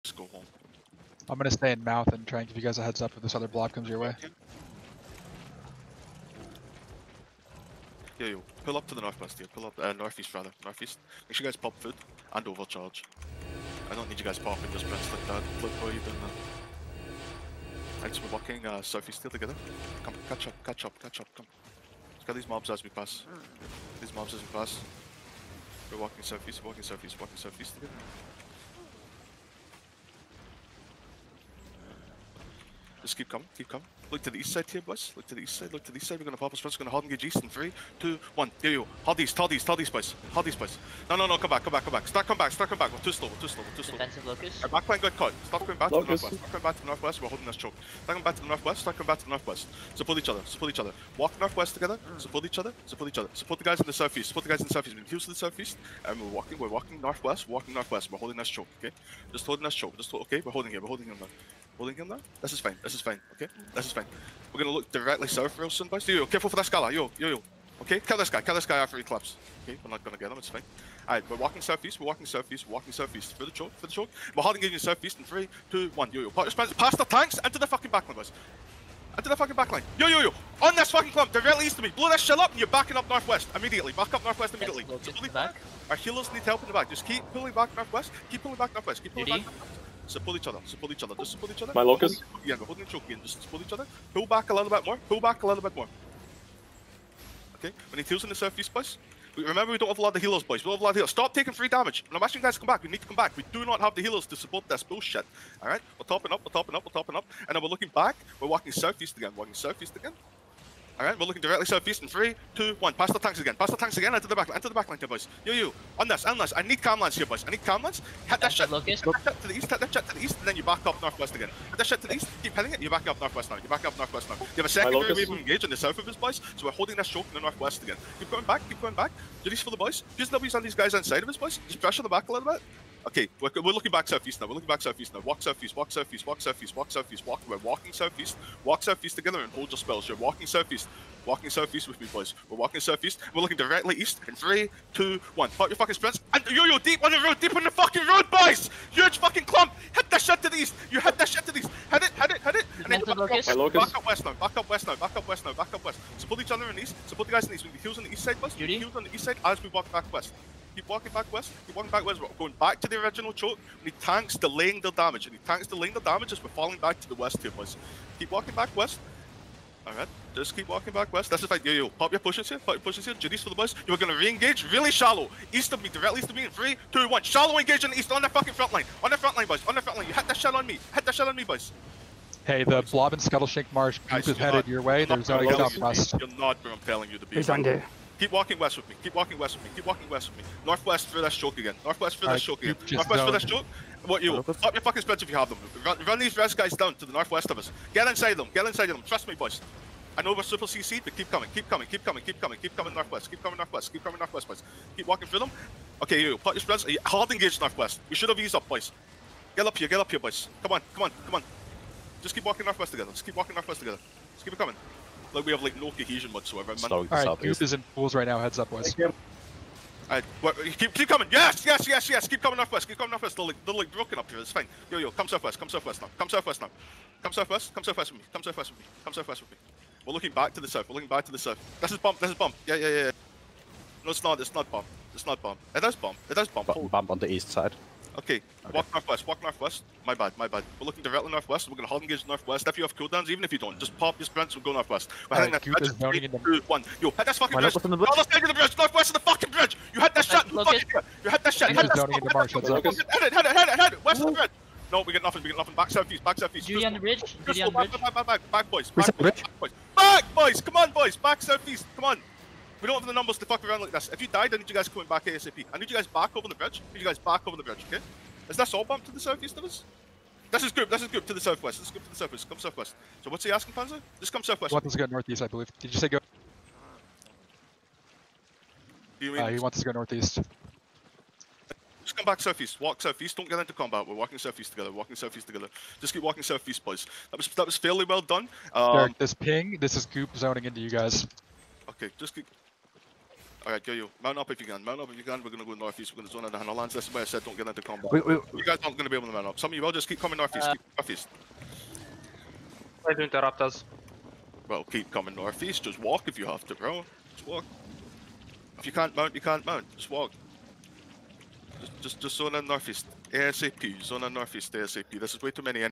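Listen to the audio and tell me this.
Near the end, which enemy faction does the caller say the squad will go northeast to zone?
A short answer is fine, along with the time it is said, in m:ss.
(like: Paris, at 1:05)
Hanolans, at 4:56.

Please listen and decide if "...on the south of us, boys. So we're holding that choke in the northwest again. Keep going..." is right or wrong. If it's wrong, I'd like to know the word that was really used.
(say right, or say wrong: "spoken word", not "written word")
right.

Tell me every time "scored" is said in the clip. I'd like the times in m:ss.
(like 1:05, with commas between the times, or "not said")
not said.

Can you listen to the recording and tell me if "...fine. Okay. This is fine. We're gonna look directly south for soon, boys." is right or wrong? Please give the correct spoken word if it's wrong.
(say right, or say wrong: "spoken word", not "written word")
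right.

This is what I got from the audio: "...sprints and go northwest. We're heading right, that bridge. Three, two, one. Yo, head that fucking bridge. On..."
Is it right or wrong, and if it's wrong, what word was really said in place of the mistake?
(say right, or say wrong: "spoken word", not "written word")
right.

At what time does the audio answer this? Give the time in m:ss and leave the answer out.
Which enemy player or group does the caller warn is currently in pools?
3:37.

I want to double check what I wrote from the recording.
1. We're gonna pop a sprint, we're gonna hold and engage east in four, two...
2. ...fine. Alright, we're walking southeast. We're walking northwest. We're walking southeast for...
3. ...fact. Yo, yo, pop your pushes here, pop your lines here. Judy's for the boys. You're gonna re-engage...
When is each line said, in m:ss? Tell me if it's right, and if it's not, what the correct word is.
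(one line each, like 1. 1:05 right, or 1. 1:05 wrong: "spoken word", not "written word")
1. 0:36 wrong: "three", not "four"
2. 1:10 wrong: "southeast", not "northwest"
3. 2:51 wrong: "pushes", not "lines".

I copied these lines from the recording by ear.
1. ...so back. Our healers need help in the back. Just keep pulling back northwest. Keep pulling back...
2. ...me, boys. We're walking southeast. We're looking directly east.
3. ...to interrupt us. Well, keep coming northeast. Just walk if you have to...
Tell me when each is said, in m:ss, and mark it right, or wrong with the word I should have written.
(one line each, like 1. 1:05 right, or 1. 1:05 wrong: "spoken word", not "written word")
1. 1:25 right
2. 2:22 right
3. 5:03 right.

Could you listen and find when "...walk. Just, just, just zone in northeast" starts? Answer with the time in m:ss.
5:10.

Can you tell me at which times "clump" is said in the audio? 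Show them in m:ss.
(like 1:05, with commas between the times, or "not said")
1:21, 2:29.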